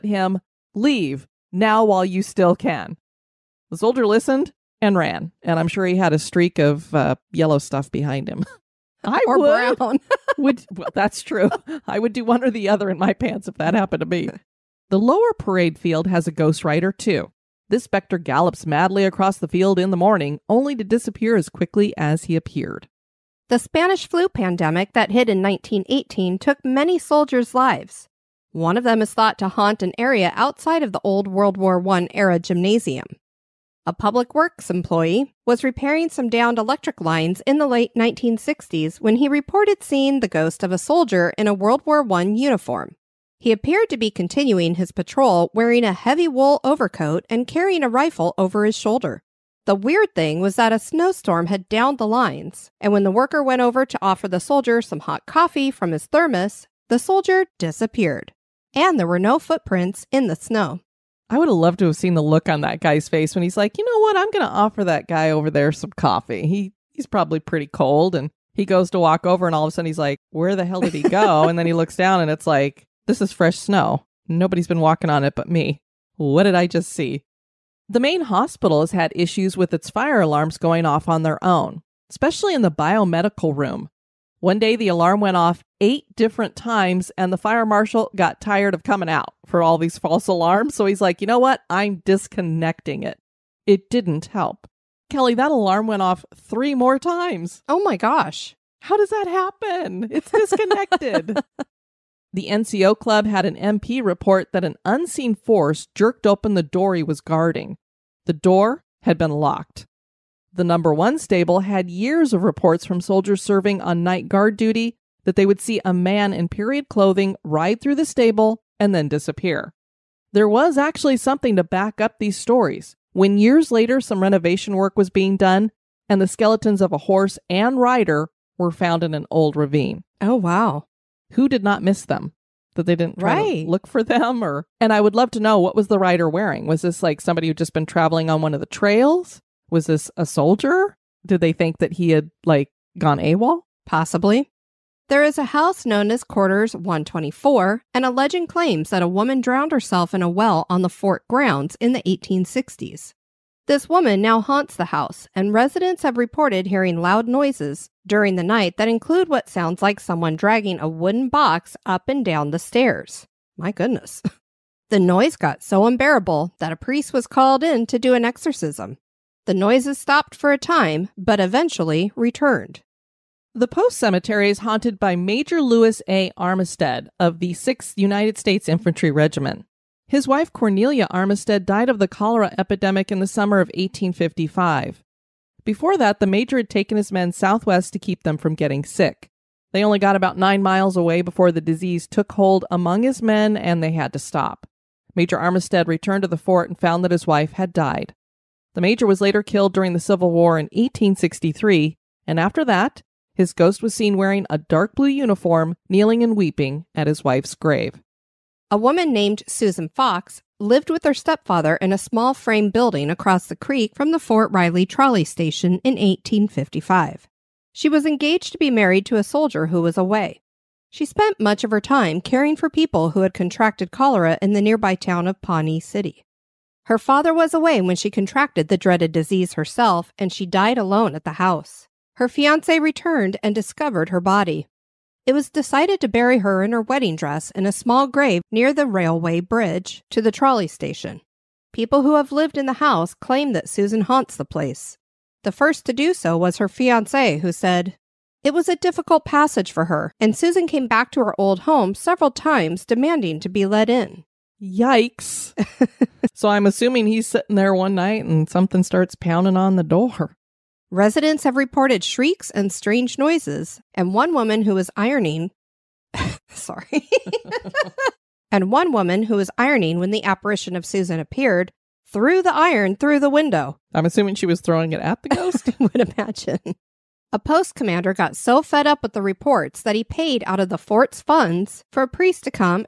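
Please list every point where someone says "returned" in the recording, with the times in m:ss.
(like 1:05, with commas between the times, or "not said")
2:52, 3:15, 3:52.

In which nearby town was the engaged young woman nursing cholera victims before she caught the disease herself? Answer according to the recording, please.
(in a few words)
Pawnee City.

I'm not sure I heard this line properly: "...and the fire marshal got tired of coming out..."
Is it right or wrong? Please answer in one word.
right.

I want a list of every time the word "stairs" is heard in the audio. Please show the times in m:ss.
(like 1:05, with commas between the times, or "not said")
2:42.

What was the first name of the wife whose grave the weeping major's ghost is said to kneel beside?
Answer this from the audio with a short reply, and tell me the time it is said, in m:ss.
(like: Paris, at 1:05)
Cornelia, at 3:00.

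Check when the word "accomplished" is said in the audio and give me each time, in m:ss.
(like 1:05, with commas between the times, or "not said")
not said.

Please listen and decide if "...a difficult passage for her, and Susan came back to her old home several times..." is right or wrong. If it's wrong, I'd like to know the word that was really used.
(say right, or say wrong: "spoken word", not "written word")
right.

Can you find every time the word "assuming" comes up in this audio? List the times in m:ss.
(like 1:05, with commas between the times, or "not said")
4:16, 4:34.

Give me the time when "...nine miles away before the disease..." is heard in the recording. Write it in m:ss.
3:10.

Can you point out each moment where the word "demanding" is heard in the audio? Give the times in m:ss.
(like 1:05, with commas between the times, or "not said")
4:12.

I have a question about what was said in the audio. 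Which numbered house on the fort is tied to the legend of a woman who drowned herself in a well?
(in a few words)
Quarters 124.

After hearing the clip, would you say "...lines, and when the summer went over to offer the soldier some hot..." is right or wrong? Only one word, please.
wrong.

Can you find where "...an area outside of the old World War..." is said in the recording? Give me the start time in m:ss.
0:29.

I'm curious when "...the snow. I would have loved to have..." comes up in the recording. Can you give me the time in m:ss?
1:00.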